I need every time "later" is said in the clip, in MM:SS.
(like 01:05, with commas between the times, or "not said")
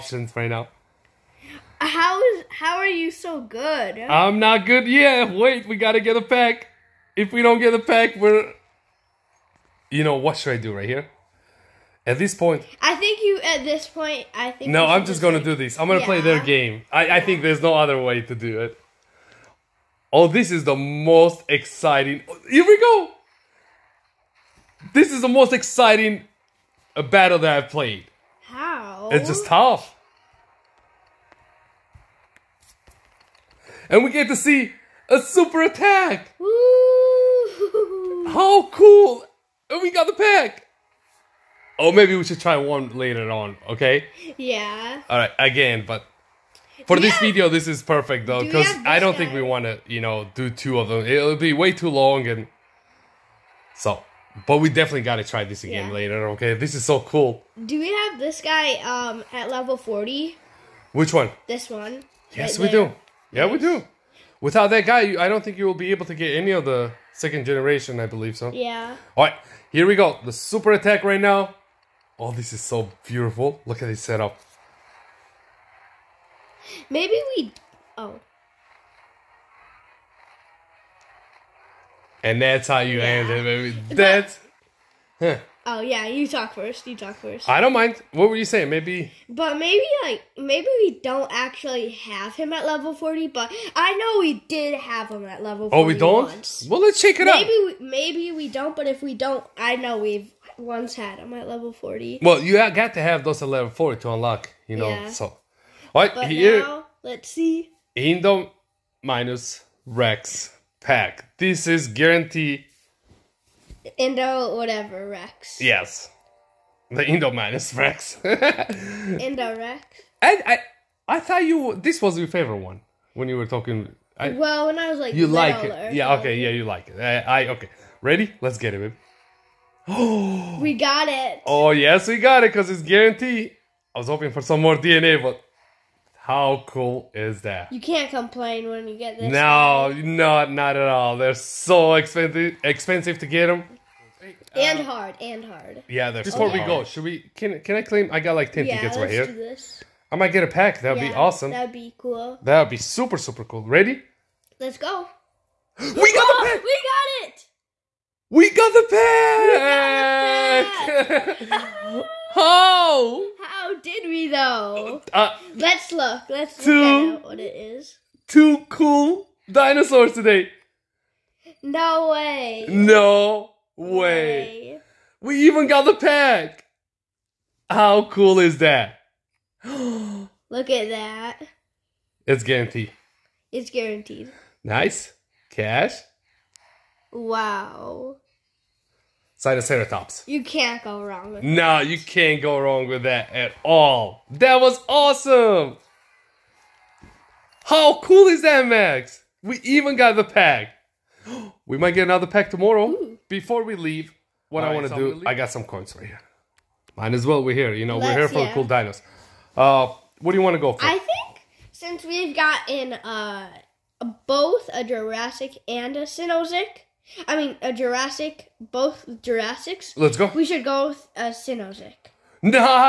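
00:42, 00:55.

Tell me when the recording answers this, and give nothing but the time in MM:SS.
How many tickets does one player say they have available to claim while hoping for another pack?
02:28.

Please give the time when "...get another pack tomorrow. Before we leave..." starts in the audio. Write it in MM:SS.
03:21.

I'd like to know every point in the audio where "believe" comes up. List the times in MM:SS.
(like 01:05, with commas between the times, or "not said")
01:08.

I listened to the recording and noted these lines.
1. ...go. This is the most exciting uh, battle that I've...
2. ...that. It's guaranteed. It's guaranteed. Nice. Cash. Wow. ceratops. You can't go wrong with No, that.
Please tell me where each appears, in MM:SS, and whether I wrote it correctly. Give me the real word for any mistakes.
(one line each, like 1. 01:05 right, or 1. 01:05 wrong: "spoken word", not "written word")
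1. 00:22 right
2. 03:00 right.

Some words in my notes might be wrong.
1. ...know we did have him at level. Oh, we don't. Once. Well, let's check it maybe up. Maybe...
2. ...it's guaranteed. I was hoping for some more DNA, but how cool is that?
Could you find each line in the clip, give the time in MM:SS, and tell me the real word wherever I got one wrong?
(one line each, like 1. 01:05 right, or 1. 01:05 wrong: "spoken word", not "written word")
1. 01:33 right
2. 02:12 right.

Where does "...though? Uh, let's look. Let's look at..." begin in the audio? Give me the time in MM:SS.
02:44.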